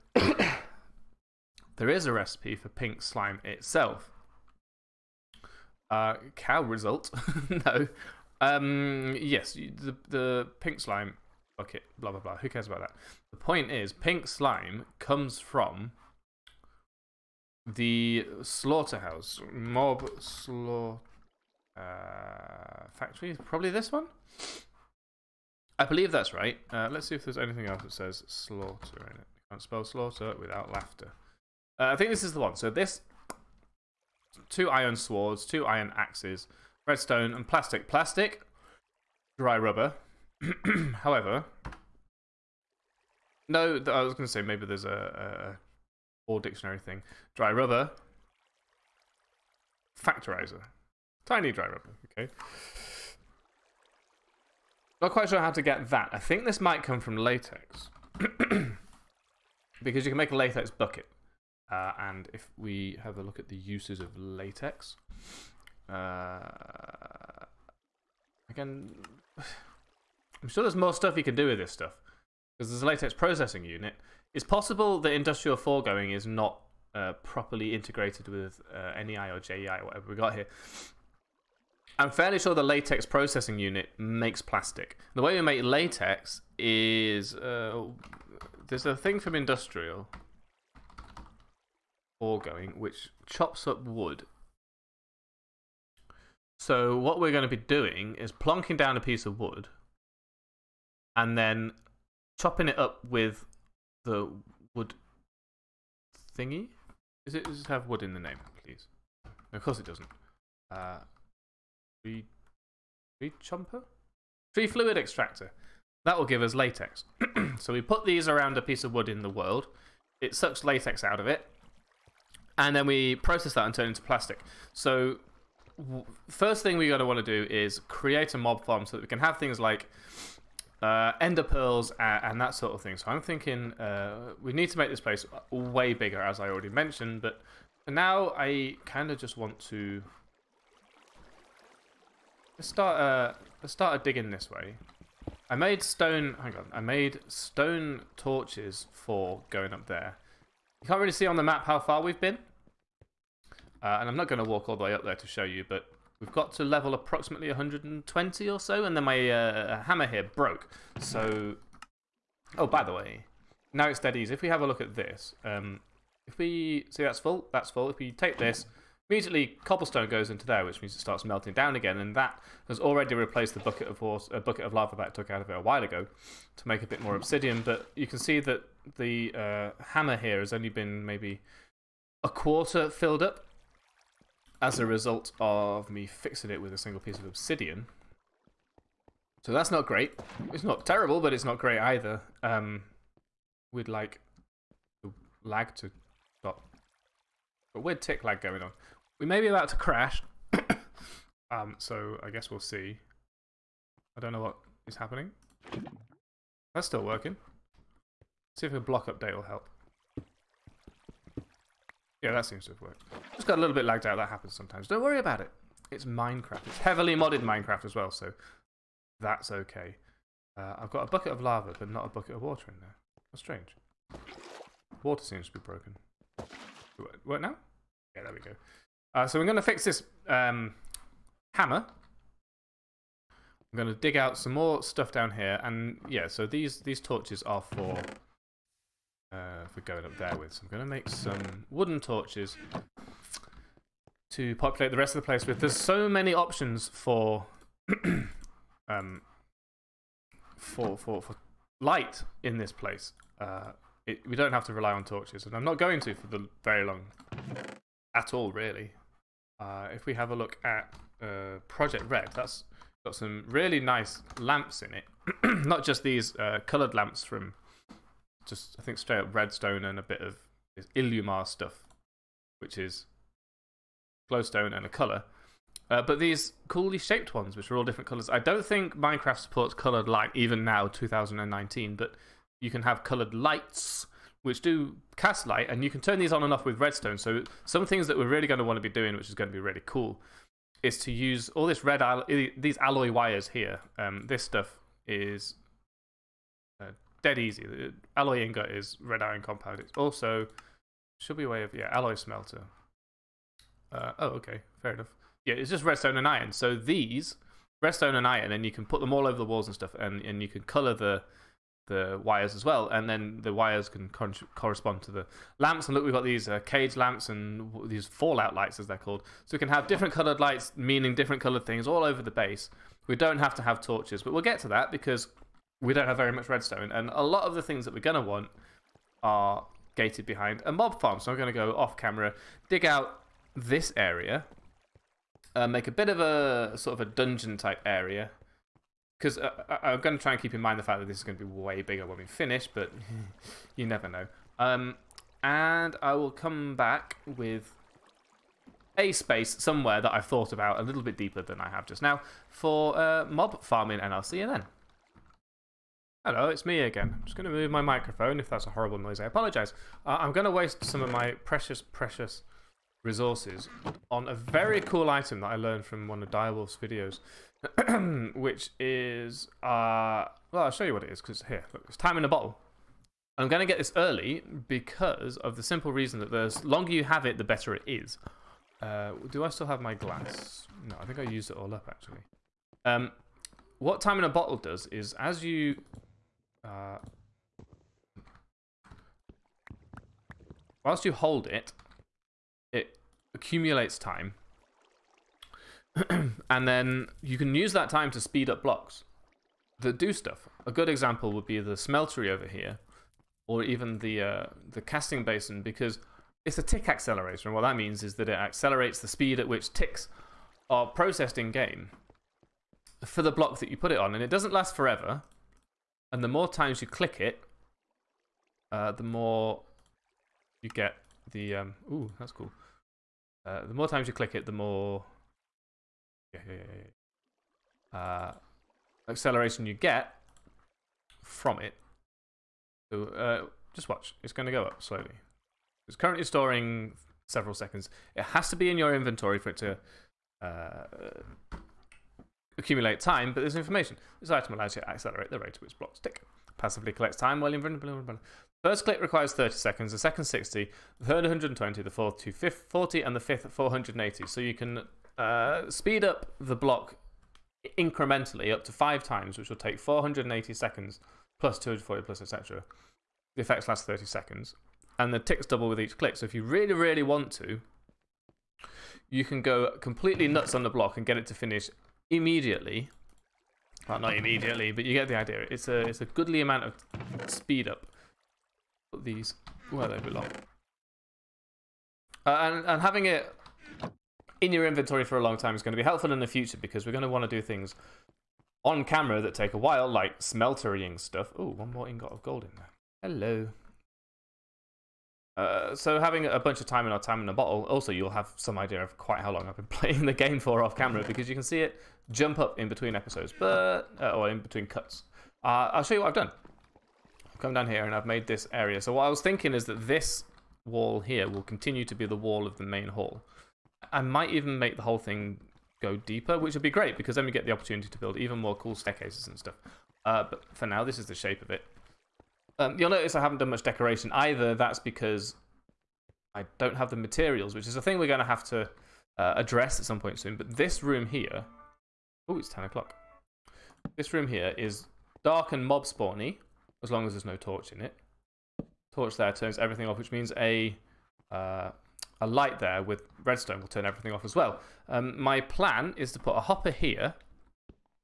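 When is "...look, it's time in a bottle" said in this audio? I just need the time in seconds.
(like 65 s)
371 s.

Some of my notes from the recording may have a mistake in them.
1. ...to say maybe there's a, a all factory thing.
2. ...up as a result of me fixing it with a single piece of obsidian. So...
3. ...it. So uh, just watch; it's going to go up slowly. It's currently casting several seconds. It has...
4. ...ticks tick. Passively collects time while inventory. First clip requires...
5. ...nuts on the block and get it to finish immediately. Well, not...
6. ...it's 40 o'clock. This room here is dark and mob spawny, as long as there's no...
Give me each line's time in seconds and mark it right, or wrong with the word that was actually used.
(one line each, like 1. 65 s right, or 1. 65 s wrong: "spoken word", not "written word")
1. 44 s wrong: "dictionary", not "factory"
2. 183 s right
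3. 431 s wrong: "storing", not "casting"
4. 445 s wrong: "blocks", not "ticks"
5. 470 s right
6. 532 s wrong: "10", not "40".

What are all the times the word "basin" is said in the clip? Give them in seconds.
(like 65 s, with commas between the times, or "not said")
405 s.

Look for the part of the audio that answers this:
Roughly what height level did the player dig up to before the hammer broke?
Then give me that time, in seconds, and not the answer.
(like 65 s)
156 s.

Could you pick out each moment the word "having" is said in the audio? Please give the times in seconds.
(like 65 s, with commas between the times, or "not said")
482 s, 495 s.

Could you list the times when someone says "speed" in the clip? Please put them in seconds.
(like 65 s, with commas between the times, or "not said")
398 s, 409 s, 455 s, 477 s.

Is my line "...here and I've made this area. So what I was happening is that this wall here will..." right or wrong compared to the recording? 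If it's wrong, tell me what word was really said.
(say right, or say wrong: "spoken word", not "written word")
wrong: "thinking", not "happening".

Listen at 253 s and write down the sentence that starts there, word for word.
Uh, it, we don't have to rely on torches, and I'm not going to for the very long at all, really.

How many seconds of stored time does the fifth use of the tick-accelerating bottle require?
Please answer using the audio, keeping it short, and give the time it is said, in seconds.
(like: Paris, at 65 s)
480, at 453 s.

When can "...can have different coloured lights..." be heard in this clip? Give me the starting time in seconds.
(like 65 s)
319 s.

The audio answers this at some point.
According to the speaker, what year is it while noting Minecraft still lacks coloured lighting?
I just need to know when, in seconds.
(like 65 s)
280 s.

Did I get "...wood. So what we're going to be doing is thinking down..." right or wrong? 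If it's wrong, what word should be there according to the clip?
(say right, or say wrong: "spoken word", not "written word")
wrong: "plonking", not "thinking".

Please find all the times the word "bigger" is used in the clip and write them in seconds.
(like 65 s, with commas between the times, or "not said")
135 s, 341 s.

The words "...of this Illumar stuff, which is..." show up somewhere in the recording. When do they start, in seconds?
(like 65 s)
270 s.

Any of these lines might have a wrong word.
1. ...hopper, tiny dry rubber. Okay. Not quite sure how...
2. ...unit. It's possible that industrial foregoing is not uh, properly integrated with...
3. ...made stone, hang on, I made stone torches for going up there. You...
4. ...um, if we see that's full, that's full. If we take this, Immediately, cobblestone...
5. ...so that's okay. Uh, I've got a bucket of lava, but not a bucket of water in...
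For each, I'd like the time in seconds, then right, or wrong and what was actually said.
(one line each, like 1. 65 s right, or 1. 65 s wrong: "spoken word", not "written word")
1. 50 s wrong: "factorizer", not "hopper"
2. 73 s right
3. 145 s right
4. 165 s right
5. 218 s right.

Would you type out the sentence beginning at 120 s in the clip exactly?
It sucks latex out of it.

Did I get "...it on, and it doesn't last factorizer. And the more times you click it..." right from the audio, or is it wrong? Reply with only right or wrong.
wrong.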